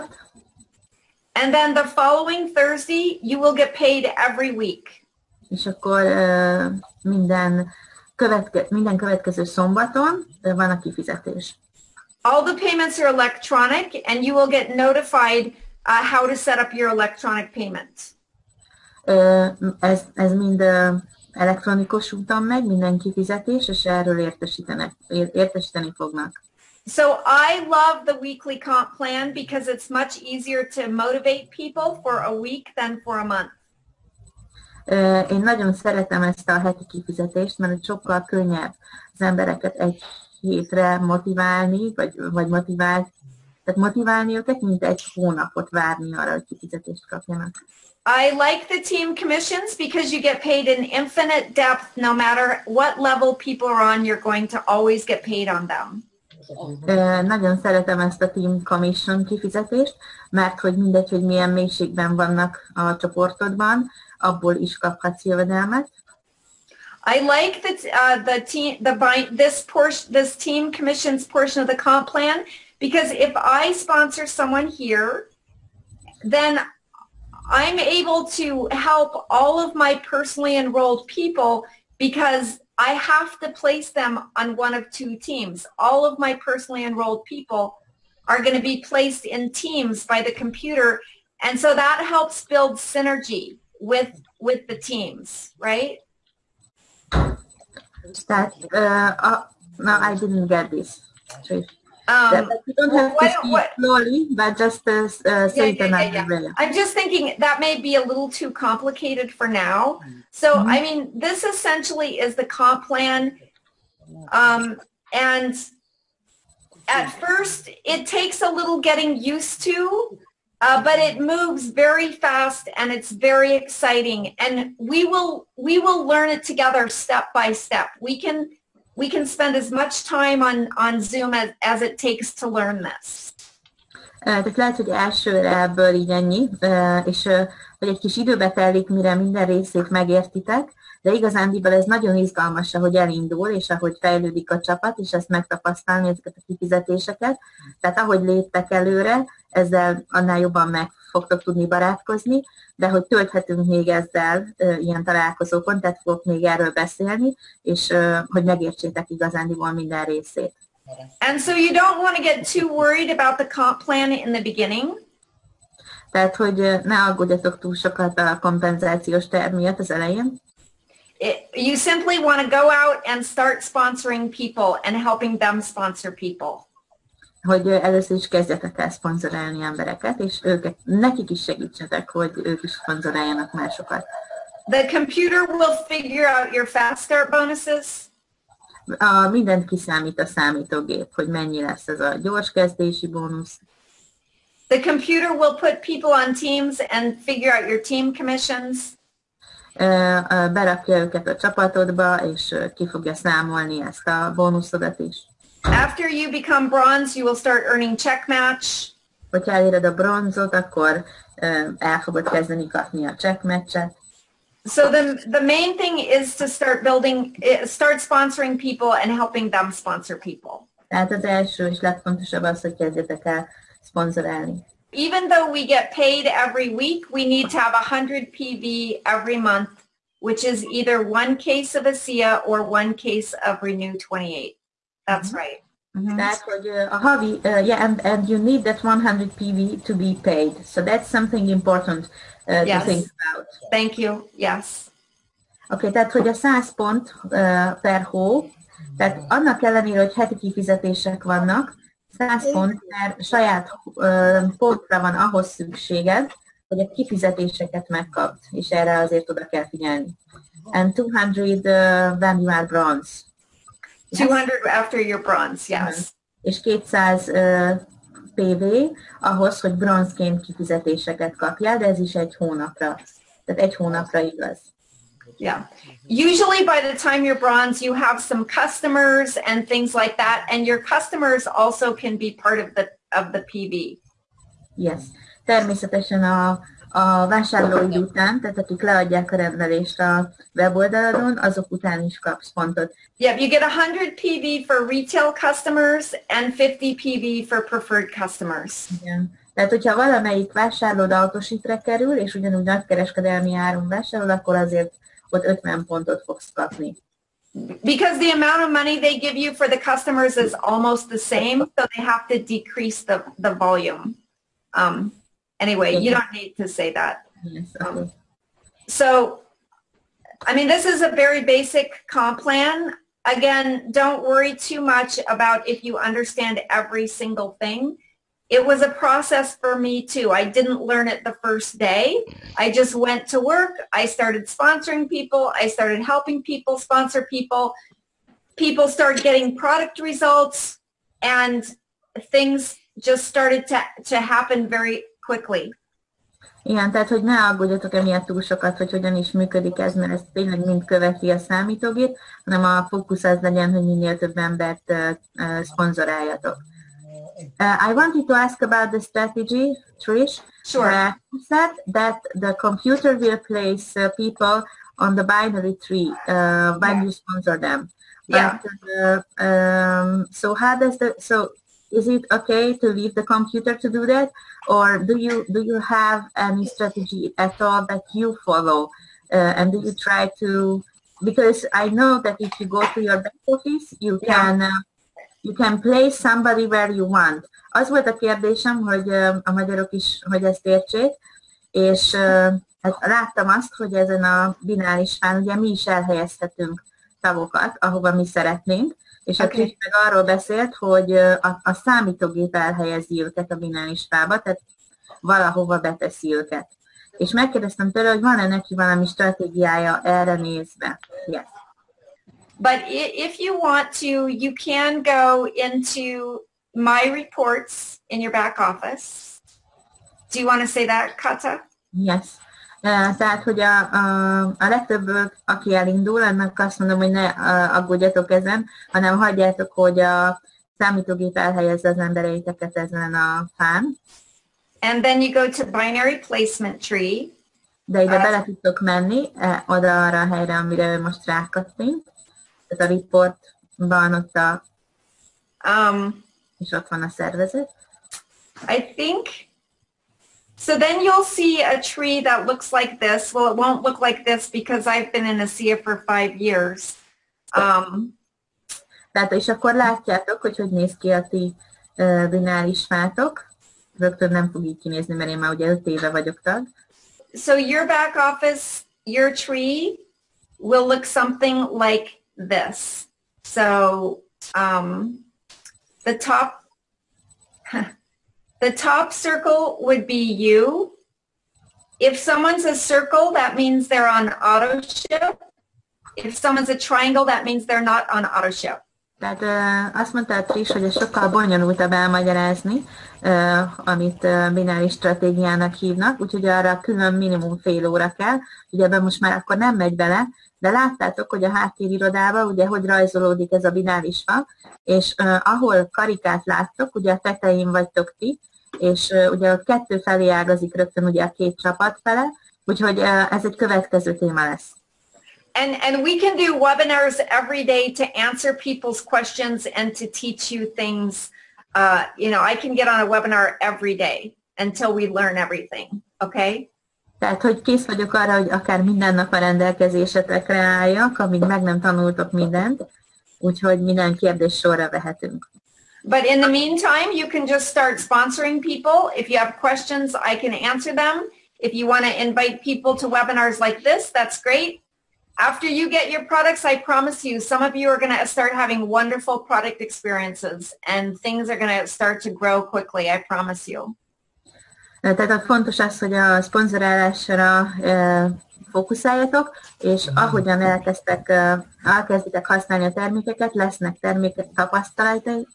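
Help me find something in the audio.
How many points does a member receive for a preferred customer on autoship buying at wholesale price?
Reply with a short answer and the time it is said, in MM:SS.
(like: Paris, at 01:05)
50 PV, at 04:56.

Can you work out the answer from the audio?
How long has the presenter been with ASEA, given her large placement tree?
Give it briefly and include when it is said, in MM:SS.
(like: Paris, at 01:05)
5 years, at 07:36.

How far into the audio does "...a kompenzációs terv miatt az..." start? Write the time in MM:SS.
02:48.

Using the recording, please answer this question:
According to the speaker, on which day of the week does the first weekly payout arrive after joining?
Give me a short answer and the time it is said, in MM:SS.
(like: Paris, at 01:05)
Thursday, at 00:02.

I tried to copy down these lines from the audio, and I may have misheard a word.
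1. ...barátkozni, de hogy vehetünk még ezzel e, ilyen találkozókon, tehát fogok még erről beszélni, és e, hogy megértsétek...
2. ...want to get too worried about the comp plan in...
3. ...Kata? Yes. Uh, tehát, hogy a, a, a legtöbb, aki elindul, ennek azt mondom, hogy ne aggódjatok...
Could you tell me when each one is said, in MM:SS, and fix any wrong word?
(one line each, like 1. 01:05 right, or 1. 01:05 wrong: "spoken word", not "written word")
1. 02:31 wrong: "tölthetünk", not "vehetünk"
2. 02:42 right
3. 07:01 right.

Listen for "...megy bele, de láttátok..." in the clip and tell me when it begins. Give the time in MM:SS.
08:19.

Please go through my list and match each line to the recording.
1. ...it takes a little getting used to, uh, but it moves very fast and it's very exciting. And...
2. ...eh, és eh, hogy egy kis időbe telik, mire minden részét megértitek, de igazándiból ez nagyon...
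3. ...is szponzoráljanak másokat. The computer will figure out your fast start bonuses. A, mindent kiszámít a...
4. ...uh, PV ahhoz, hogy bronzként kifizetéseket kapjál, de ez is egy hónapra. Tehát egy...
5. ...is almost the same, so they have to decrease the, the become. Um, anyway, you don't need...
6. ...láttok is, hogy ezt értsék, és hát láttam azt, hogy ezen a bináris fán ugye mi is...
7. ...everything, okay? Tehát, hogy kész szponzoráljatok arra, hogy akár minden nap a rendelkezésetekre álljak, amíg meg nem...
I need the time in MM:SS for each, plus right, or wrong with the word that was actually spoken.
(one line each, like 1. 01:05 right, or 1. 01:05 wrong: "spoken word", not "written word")
1. 01:57 right
2. 02:16 right
3. 03:02 right
4. 04:27 right
5. 05:10 wrong: "volume", not "become"
6. 06:29 wrong: "magyarok", not "láttok"
7. 08:45 wrong: "vagyok", not "szponzoráljatok".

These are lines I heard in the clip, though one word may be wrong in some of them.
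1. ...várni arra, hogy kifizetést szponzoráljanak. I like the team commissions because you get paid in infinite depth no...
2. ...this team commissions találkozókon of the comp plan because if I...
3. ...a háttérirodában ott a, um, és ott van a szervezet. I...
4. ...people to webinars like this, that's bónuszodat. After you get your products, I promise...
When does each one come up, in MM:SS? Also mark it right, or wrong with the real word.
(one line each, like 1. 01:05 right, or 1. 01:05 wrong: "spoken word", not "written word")
1. 00:45 wrong: "kapjanak", not "szponzoráljanak"
2. 01:10 wrong: "portion", not "találkozókon"
3. 07:22 wrong: "reportban", not "háttérirodában"
4. 09:02 wrong: "great", not "bónuszodat".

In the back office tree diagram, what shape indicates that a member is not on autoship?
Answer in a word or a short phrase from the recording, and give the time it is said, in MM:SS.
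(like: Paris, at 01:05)
Triangle, at 08:06.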